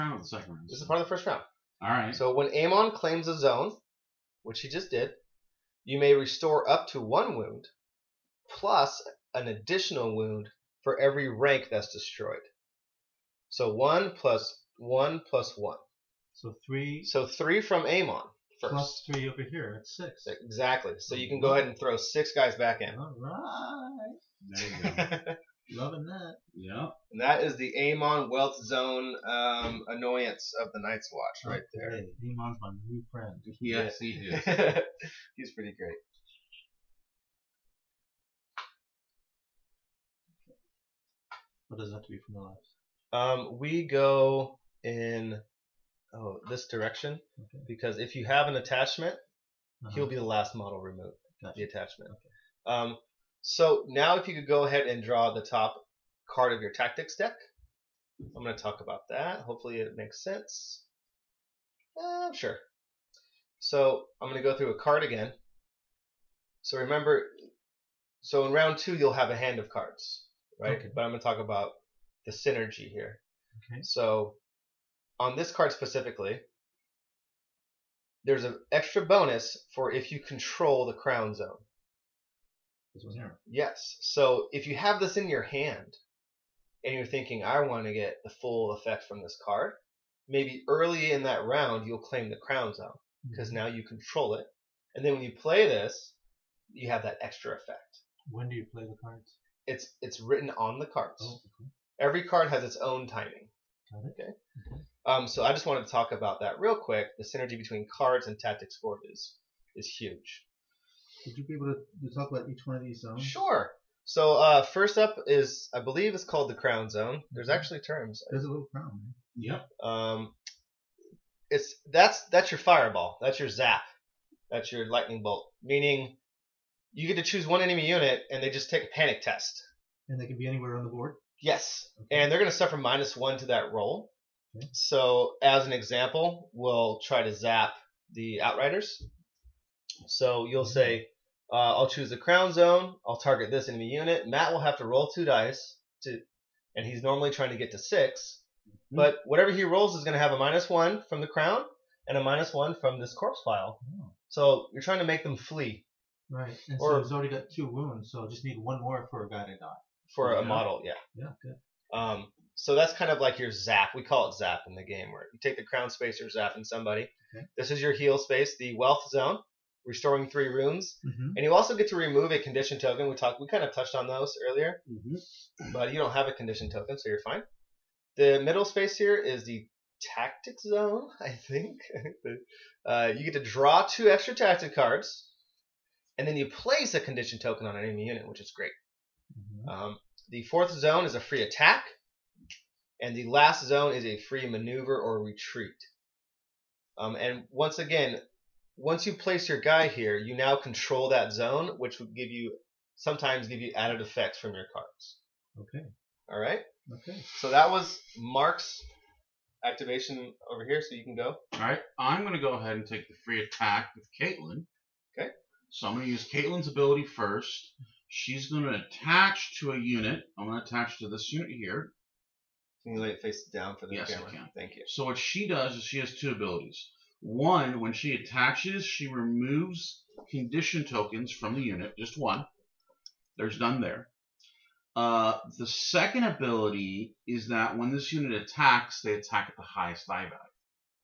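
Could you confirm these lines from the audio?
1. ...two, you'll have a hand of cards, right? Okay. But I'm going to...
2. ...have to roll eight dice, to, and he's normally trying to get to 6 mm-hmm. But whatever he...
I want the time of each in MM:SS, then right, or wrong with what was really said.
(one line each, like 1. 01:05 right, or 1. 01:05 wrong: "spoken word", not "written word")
1. 01:08 right
2. 02:24 wrong: "two", not "eight".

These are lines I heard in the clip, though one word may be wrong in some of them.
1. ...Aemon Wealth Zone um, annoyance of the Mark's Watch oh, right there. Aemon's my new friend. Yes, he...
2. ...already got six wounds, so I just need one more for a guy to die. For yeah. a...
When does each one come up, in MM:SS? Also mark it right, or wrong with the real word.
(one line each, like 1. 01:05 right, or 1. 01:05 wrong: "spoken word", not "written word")
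1. 00:27 wrong: "Night", not "Mark"
2. 02:37 wrong: "two", not "six".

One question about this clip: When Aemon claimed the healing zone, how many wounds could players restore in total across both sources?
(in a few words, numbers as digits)
6.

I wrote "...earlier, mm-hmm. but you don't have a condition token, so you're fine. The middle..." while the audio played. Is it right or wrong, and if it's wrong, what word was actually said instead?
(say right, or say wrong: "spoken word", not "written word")
right.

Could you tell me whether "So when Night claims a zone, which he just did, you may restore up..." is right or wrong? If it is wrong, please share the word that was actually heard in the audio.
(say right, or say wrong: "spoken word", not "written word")
wrong: "Aemon", not "Night".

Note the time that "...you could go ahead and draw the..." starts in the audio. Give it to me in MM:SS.
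00:54.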